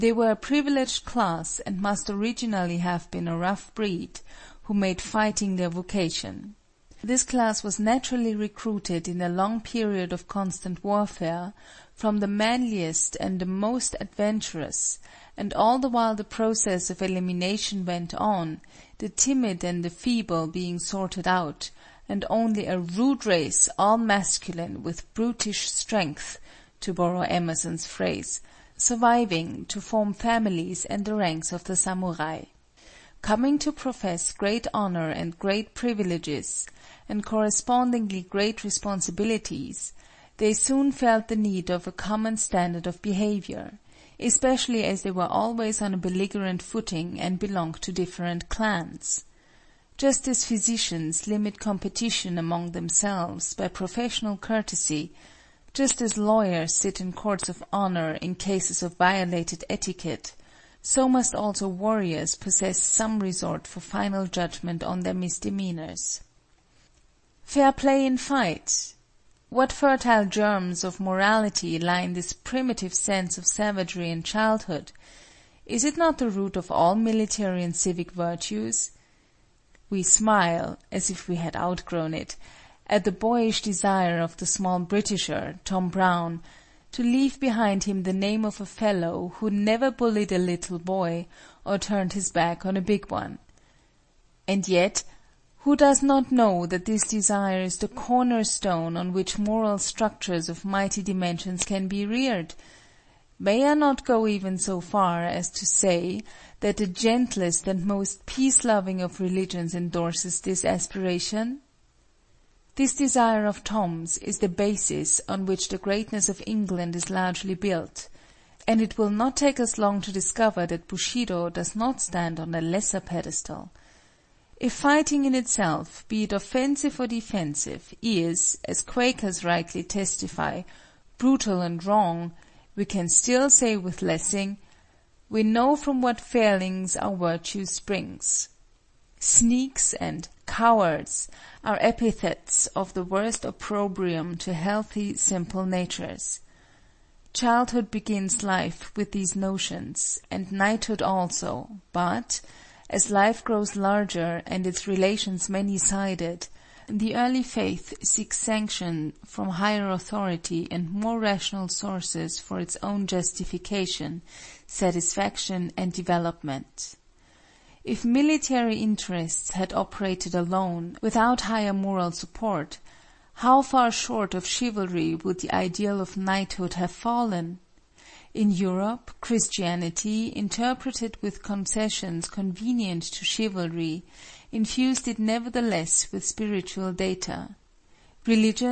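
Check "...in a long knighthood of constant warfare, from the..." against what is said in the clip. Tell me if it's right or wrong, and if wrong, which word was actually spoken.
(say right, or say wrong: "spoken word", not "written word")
wrong: "period", not "knighthood".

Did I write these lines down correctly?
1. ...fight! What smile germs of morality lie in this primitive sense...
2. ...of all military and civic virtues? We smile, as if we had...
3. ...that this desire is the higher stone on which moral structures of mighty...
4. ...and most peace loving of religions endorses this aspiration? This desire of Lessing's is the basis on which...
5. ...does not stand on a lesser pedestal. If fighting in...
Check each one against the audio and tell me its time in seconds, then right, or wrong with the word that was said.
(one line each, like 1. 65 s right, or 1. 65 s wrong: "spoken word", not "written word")
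1. 68 s wrong: "fertile", not "smile"
2. 76 s right
3. 96 s wrong: "corner", not "higher"
4. 107 s wrong: "Tom", not "Lessing"
5. 121 s right.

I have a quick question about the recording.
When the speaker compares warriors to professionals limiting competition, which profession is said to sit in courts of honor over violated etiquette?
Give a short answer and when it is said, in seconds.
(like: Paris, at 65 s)
lawyers, at 56 s.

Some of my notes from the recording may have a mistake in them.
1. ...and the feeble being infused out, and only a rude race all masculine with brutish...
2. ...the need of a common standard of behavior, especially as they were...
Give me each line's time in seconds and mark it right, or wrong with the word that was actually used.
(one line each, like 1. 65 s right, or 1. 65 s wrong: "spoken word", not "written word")
1. 19 s wrong: "sorted", not "infused"
2. 41 s right.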